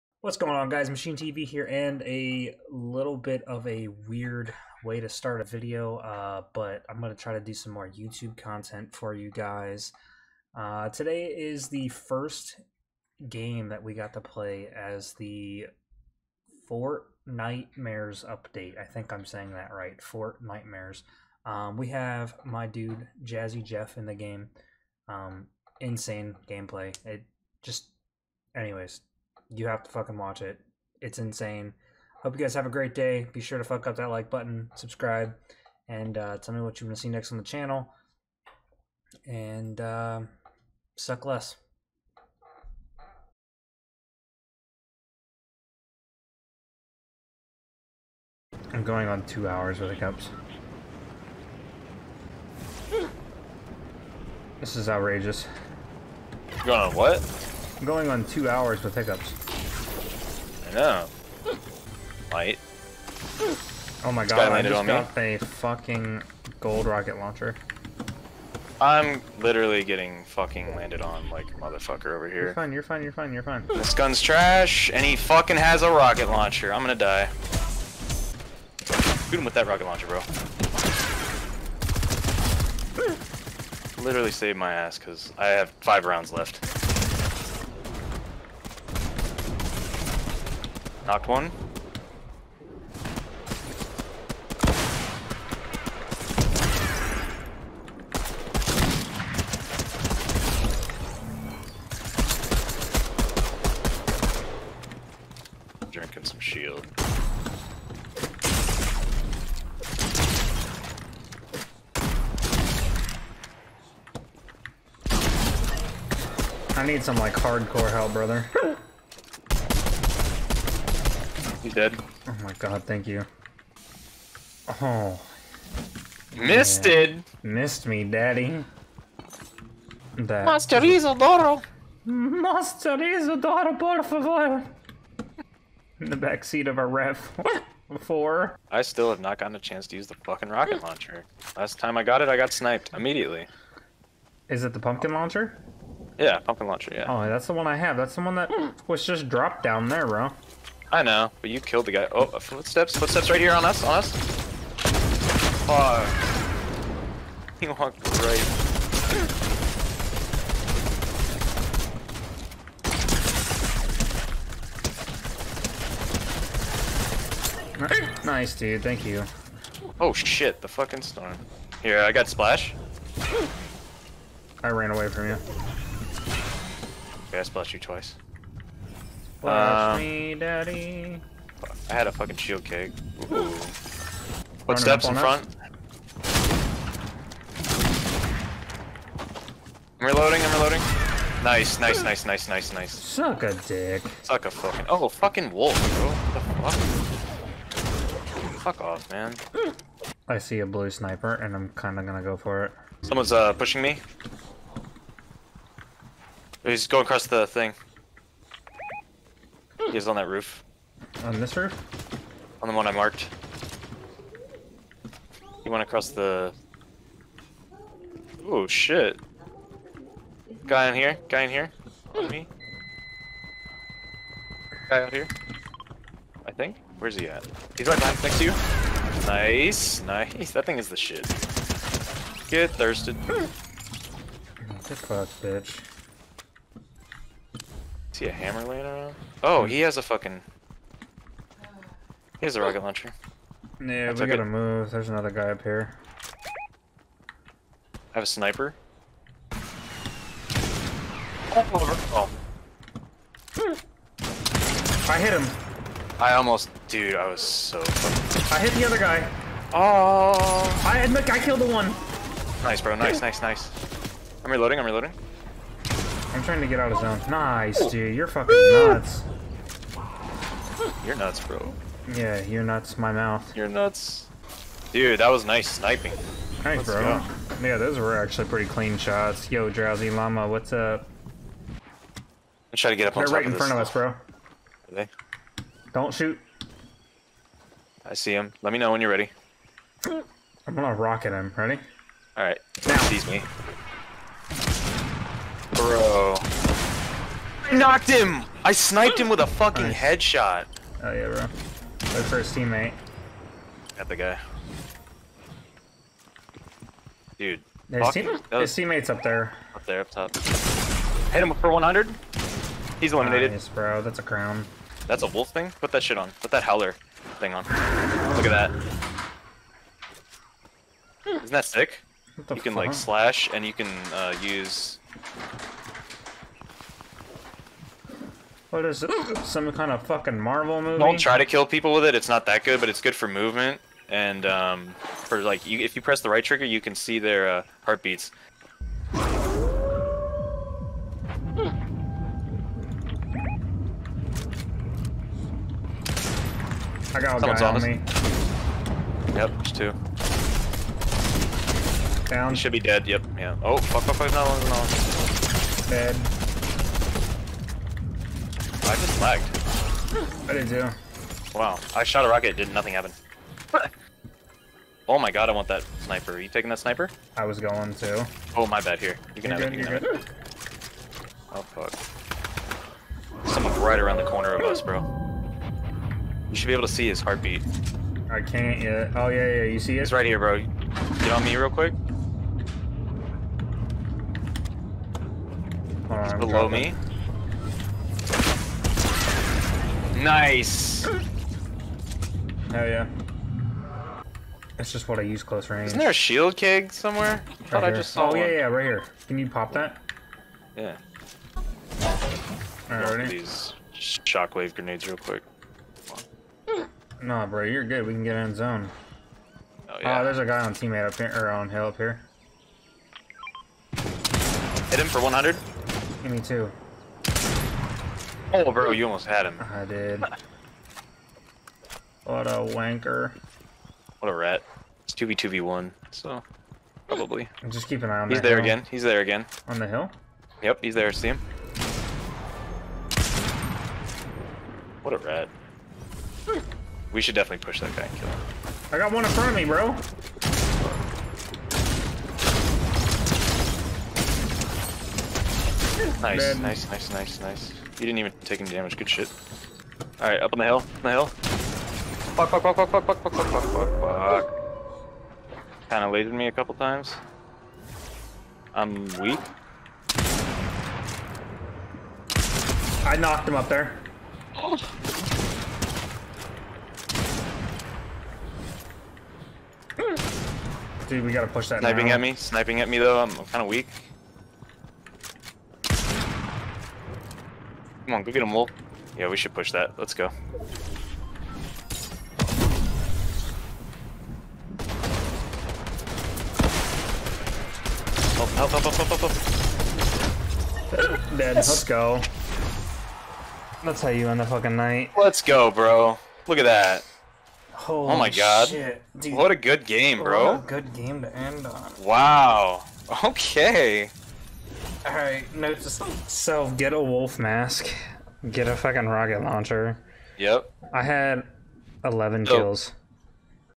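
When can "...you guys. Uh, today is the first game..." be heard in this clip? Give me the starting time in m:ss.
0:09.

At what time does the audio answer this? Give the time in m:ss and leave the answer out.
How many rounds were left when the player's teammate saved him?
1:25.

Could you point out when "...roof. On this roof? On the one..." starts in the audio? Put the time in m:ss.
3:30.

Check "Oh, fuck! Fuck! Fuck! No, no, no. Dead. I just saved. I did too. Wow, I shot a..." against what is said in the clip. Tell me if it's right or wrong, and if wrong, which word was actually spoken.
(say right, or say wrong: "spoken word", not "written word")
wrong: "lagged", not "saved".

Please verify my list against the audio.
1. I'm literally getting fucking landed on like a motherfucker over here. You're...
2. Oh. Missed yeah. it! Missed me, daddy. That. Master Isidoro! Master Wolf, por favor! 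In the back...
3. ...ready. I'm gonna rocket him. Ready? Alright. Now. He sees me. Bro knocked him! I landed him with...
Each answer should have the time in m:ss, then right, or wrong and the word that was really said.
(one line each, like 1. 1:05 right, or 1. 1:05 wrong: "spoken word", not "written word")
1. 1:08 right
2. 2:04 wrong: "Isidoro", not "Wolf"
3. 4:49 wrong: "sniped", not "landed".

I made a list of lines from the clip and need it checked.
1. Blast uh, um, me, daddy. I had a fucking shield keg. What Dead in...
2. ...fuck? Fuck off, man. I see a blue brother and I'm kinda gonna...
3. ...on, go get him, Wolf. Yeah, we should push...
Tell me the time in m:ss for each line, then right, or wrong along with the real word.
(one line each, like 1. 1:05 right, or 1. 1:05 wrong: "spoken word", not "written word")
1. 2:59 wrong: "Footsteps", not "Dead"
2. 3:17 wrong: "sniper", not "brother"
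3. 7:58 right.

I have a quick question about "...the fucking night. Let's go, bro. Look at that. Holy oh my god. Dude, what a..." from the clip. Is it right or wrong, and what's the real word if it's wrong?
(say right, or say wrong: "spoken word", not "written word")
right.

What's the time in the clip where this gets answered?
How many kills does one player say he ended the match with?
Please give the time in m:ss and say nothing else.
8:32.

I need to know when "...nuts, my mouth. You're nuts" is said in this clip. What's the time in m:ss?
4:32.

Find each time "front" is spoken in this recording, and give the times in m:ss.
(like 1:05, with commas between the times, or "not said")
3:05, 4:43, 7:19.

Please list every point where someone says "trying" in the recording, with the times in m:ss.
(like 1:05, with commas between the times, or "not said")
4:26, 4:42.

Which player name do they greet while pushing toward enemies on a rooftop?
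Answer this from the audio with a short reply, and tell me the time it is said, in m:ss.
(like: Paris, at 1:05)
Drowsy Llama, at 4:39.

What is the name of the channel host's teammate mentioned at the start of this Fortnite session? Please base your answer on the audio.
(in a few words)
Jazzy Jeff.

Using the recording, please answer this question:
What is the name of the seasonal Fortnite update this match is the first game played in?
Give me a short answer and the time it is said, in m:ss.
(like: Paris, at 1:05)
Fortnitemares, at 0:20.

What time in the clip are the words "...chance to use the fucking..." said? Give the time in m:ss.
2:19.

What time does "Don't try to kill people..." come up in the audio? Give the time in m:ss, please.
5:30.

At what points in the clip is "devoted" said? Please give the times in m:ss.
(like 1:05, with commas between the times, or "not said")
not said.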